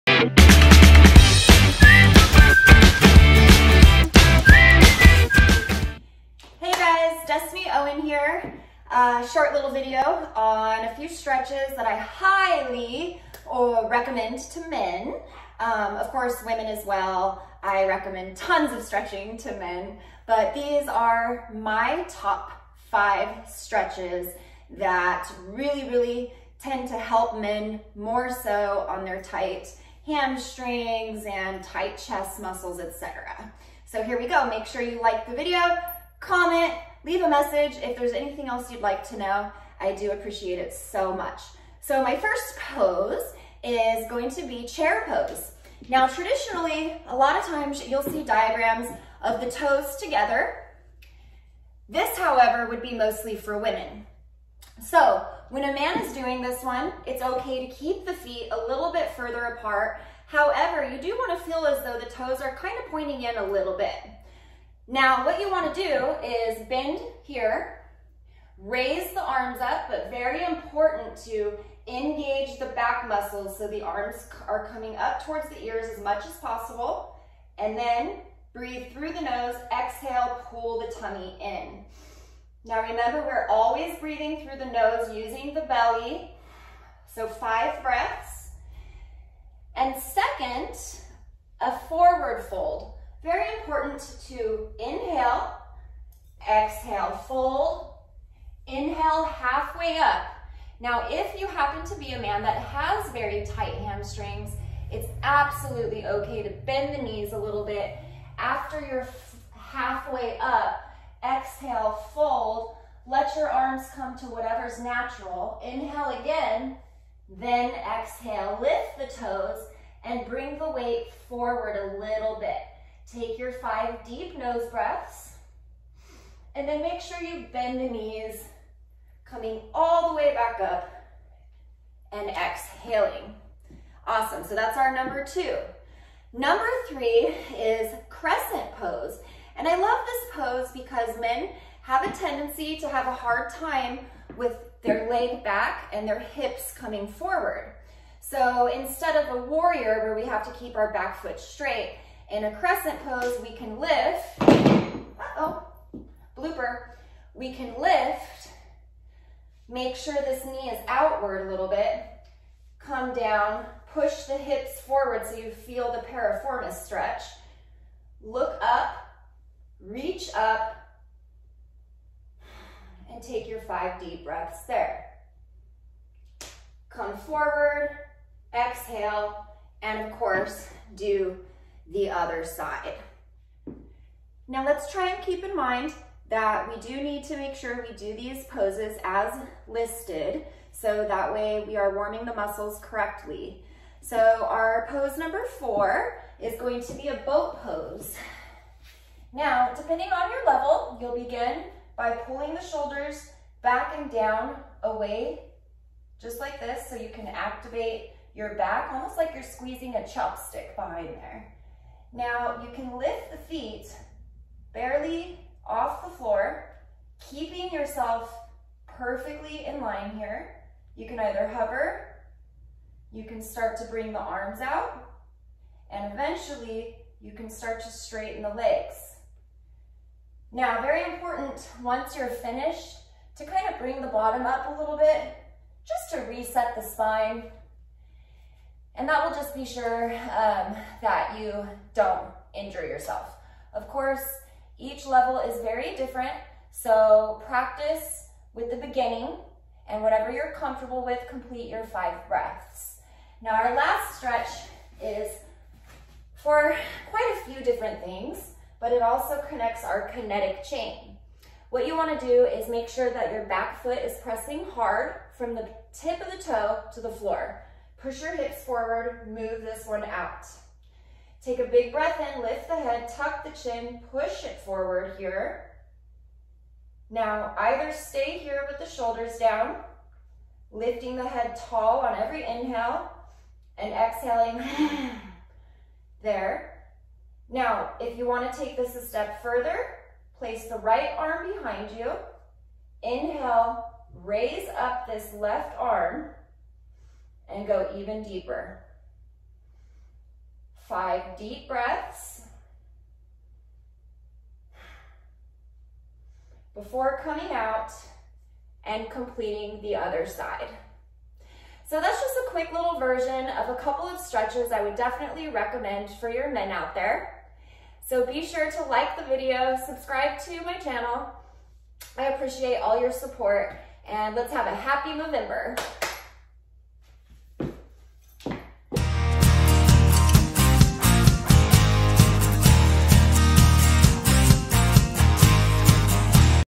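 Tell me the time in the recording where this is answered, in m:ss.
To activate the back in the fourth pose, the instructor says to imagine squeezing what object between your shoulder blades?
3:30.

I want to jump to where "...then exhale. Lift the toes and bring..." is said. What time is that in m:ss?
1:57.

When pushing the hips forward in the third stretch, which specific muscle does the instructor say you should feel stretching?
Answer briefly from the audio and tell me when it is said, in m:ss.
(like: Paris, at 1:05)
Piriformis, at 2:46.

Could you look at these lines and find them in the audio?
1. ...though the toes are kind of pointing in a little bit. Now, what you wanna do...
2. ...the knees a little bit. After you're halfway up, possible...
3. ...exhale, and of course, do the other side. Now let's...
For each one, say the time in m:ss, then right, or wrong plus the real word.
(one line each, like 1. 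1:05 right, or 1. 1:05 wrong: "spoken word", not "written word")
1. 1:01 right
2. 1:46 wrong: "exhale", not "possible"
3. 2:58 right.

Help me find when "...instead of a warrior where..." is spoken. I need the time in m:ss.
2:28.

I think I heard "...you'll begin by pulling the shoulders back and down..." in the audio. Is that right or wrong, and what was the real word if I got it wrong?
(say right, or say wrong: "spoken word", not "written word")
right.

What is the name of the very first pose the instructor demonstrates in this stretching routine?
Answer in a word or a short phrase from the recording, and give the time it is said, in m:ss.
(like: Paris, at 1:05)
Chair pose, at 0:44.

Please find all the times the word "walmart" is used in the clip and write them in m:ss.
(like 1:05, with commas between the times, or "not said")
not said.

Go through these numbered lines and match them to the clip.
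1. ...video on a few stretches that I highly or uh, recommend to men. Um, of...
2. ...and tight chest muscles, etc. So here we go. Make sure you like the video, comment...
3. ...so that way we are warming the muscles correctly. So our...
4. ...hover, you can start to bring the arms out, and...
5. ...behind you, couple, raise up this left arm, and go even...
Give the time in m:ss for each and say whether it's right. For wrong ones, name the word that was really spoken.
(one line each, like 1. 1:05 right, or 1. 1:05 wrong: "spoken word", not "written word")
1. 0:09 right
2. 0:31 right
3. 3:10 right
4. 3:41 right
5. 4:51 wrong: "inhale", not "couple".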